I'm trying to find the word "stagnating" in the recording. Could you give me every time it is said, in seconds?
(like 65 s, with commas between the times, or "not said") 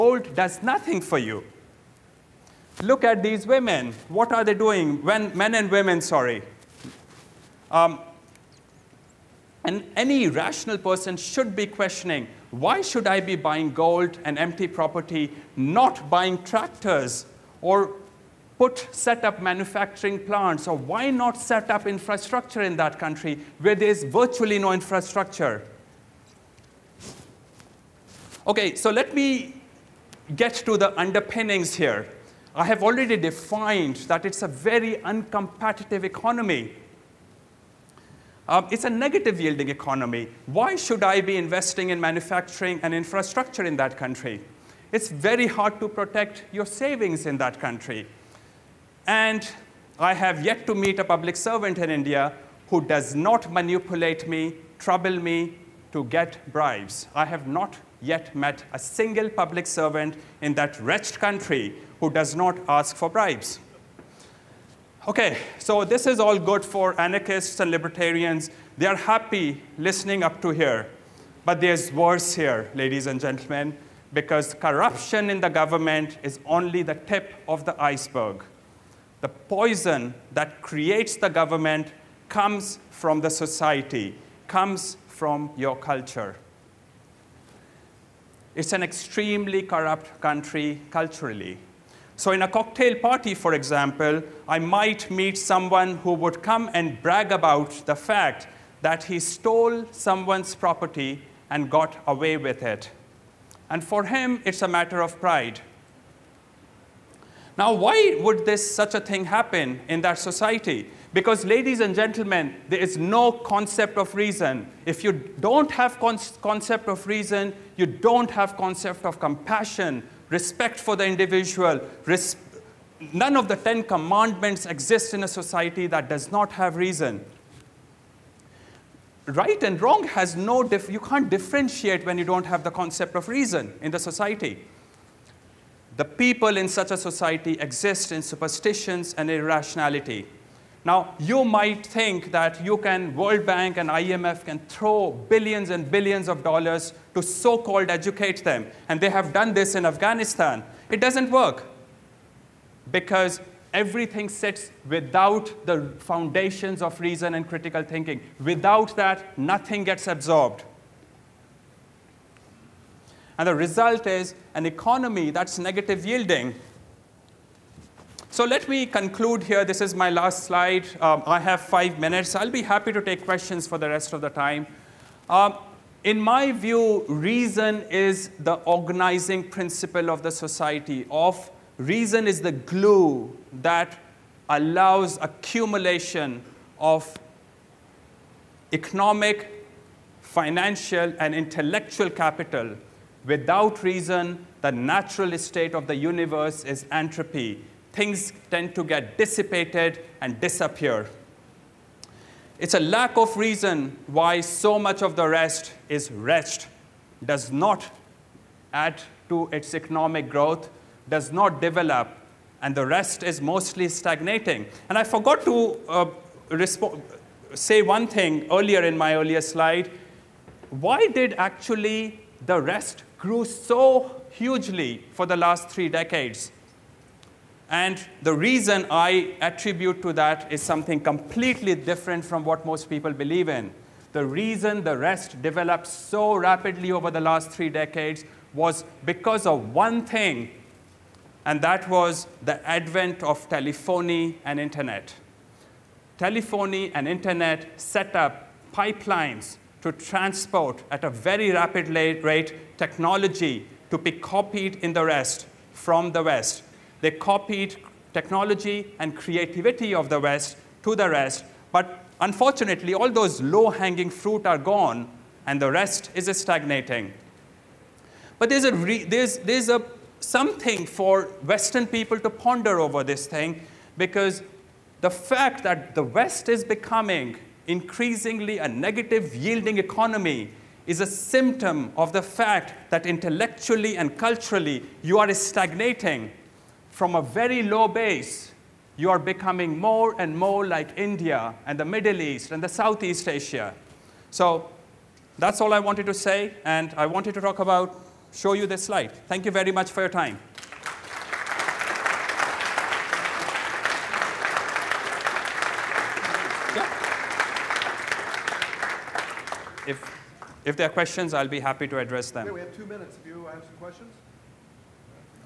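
213 s, 266 s, 285 s.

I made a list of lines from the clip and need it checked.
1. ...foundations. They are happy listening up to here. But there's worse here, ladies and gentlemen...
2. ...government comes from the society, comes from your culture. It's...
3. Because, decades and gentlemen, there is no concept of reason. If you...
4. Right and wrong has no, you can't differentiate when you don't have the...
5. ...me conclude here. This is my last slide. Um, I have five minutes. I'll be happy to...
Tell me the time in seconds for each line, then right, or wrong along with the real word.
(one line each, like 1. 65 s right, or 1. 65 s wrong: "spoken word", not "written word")
1. 67 s wrong: "libertarians", not "foundations"
2. 81 s right
3. 111 s wrong: "ladies", not "decades"
4. 129 s right
5. 168 s right.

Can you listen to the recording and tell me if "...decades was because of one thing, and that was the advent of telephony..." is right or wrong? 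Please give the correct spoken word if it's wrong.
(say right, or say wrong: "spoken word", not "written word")
right.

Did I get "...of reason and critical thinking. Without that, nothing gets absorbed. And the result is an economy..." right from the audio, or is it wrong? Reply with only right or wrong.
right.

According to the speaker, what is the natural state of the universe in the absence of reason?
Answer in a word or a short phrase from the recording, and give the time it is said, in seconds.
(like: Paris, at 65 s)
Entropy, at 196 s.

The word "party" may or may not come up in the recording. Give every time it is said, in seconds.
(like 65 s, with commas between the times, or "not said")
92 s.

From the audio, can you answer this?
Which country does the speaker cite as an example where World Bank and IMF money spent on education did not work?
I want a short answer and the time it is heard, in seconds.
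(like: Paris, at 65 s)
Afghanistan, at 149 s.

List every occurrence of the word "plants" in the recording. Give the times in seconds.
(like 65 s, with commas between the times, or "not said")
20 s.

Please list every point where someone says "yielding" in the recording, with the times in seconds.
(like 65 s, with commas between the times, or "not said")
39 s, 166 s, 279 s.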